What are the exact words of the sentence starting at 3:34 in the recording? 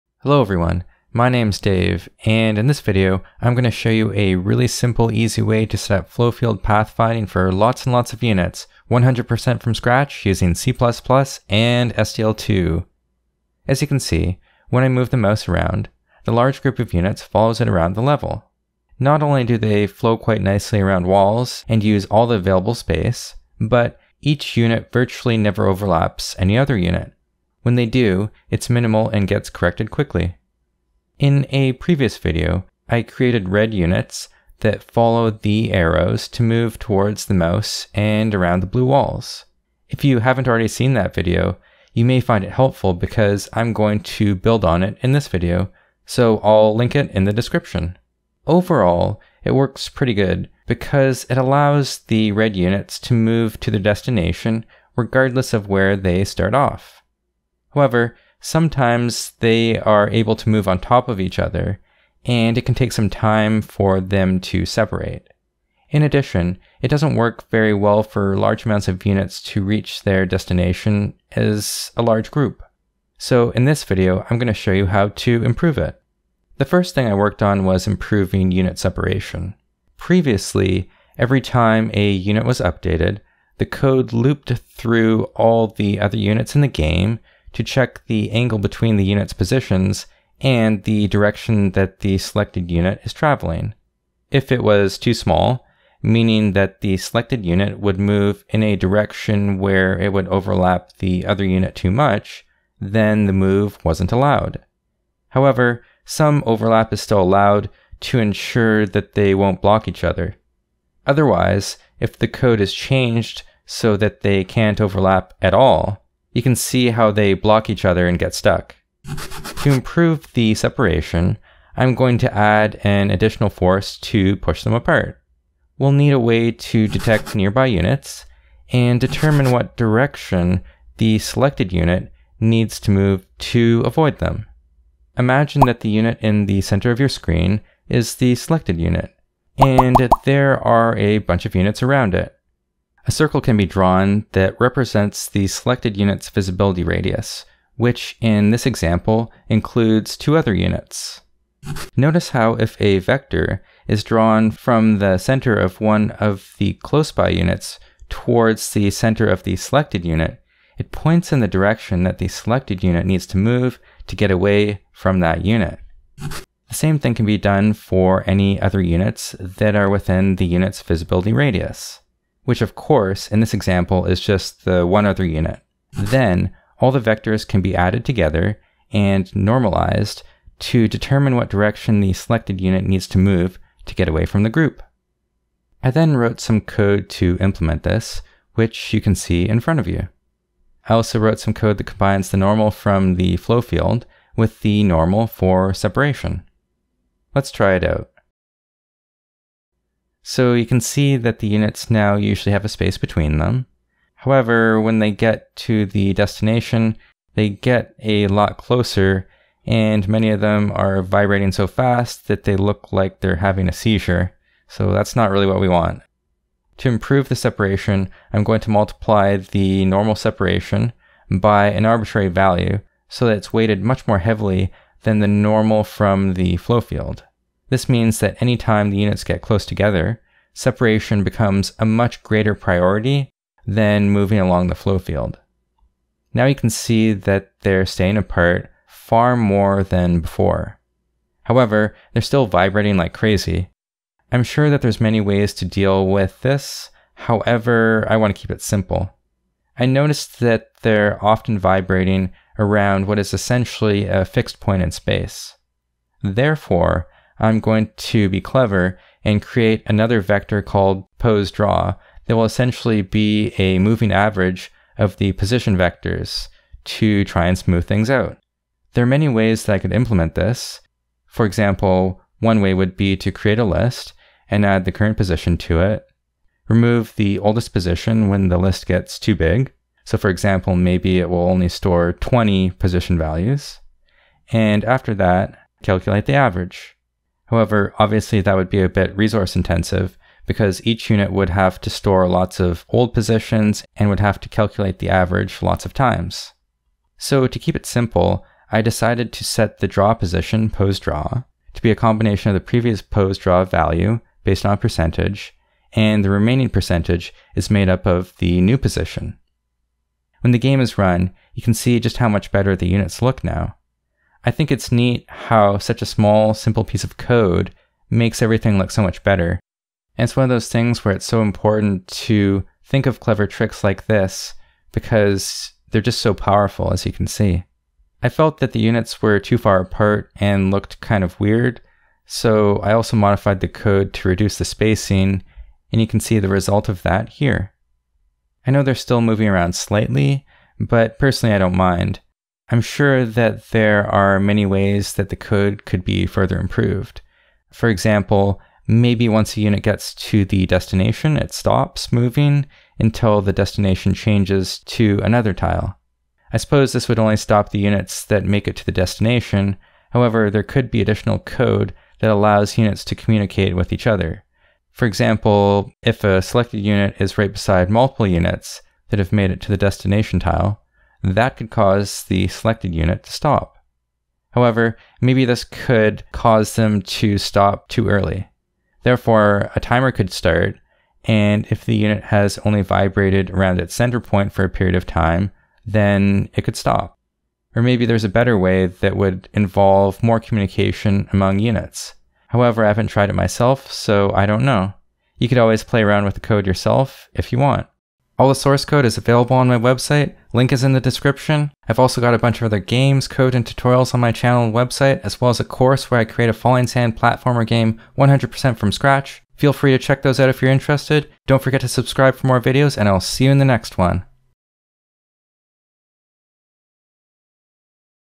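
So that's not really what we want.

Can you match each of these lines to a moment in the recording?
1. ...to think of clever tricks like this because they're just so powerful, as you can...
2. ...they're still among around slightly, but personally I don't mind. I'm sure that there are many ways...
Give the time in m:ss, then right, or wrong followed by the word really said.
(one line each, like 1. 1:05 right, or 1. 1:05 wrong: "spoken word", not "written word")
1. 5:22 right
2. 5:38 wrong: "moving", not "among".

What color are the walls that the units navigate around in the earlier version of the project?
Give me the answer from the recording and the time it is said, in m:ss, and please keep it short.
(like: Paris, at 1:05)
Blue, at 0:38.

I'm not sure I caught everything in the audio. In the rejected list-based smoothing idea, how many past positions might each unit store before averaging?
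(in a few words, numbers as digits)
20.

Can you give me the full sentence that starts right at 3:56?
Now you can see that they're staying apart far more than before.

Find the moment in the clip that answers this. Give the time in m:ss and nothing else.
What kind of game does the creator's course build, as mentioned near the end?
6:46.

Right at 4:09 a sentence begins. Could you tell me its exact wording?
I noticed that they're often vibrating around what is essentially a fixed point in space.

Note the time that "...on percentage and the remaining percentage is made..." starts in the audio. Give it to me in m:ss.
5:04.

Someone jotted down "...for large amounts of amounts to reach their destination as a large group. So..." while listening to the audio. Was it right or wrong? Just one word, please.
wrong.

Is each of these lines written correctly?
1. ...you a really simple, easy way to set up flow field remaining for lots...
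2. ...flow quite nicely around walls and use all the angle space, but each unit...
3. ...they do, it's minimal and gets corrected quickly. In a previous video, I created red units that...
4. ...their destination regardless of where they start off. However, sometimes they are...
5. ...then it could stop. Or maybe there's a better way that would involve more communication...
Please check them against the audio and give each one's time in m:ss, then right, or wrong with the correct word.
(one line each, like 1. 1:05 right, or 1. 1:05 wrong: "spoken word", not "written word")
1. 0:03 wrong: "pathfinding", not "remaining"
2. 0:19 wrong: "available", not "angle"
3. 0:27 right
4. 0:53 right
5. 6:25 right.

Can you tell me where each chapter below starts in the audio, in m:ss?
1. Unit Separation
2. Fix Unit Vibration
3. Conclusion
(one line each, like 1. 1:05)
1. 1:16
2. 3:56
3. 5:10.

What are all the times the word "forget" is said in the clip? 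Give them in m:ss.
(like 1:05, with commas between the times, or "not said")
6:51.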